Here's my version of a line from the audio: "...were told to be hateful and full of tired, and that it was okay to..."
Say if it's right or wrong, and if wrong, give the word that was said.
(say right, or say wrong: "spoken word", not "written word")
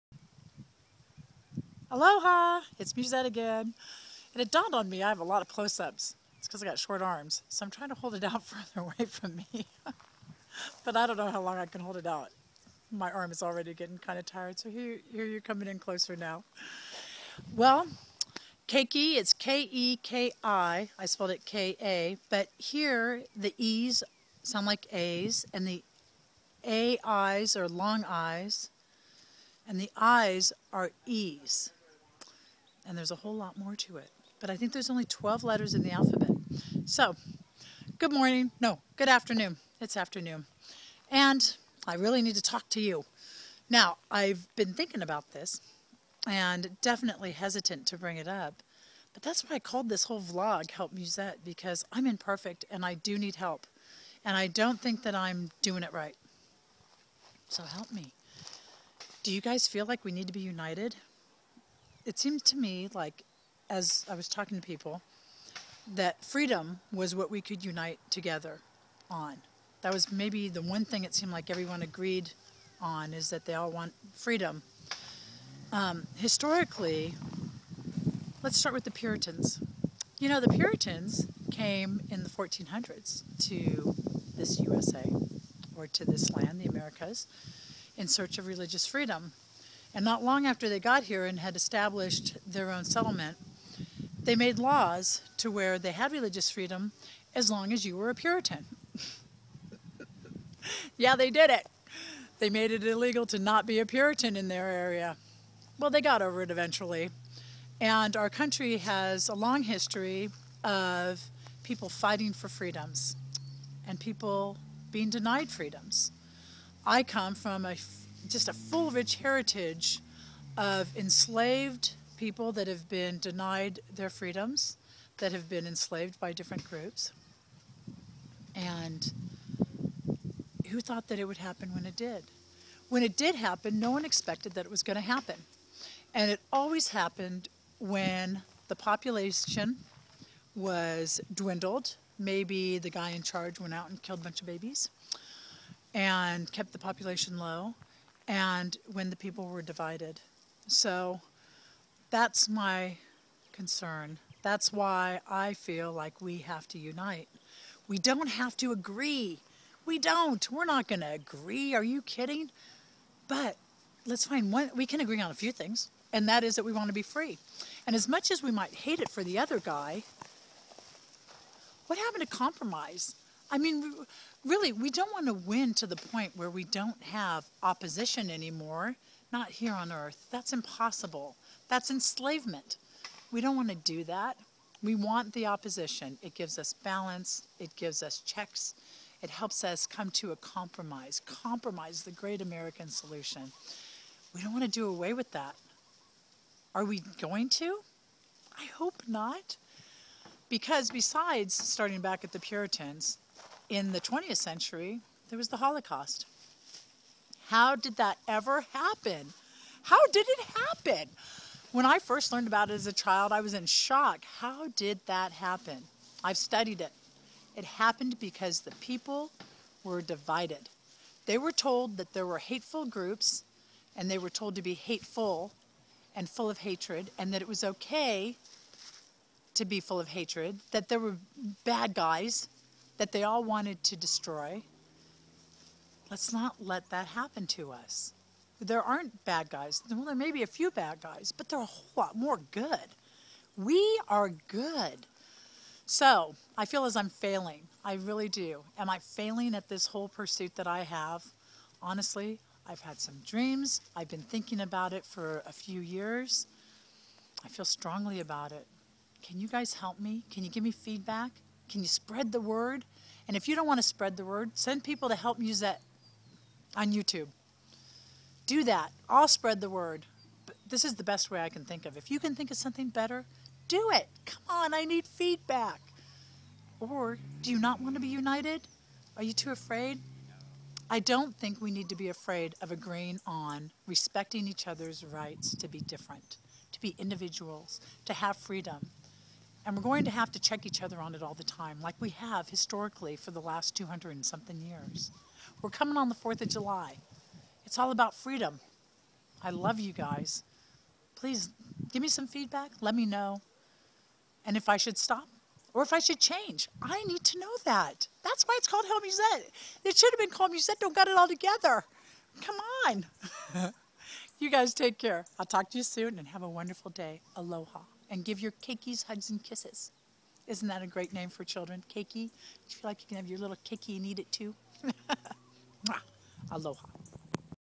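wrong: "hatred", not "tired".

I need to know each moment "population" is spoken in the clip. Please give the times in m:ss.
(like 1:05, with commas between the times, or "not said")
2:18, 2:26.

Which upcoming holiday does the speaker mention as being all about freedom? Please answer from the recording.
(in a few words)
4th of July.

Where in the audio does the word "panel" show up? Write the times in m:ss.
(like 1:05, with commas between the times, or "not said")
not said.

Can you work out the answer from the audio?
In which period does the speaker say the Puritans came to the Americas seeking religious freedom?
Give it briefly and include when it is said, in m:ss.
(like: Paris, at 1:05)
1400s, at 1:22.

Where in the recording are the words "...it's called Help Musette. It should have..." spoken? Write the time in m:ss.
5:08.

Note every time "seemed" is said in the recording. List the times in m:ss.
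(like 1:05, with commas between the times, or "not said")
1:02, 1:11.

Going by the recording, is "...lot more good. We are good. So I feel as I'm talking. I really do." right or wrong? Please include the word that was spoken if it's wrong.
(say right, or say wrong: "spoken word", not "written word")
wrong: "failing", not "talking".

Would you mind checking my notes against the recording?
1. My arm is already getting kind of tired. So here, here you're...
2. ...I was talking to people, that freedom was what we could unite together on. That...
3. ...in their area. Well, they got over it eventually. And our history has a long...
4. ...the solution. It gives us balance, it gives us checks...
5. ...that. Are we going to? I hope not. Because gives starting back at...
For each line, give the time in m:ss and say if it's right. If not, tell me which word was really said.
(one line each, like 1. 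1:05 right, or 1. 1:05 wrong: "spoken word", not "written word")
1. 0:12 right
2. 1:04 right
3. 1:44 wrong: "country", not "history"
4. 3:05 wrong: "opposition", not "solution"
5. 3:15 wrong: "besides", not "gives".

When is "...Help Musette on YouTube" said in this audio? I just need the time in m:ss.
4:25.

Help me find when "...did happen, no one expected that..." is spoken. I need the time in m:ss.
2:13.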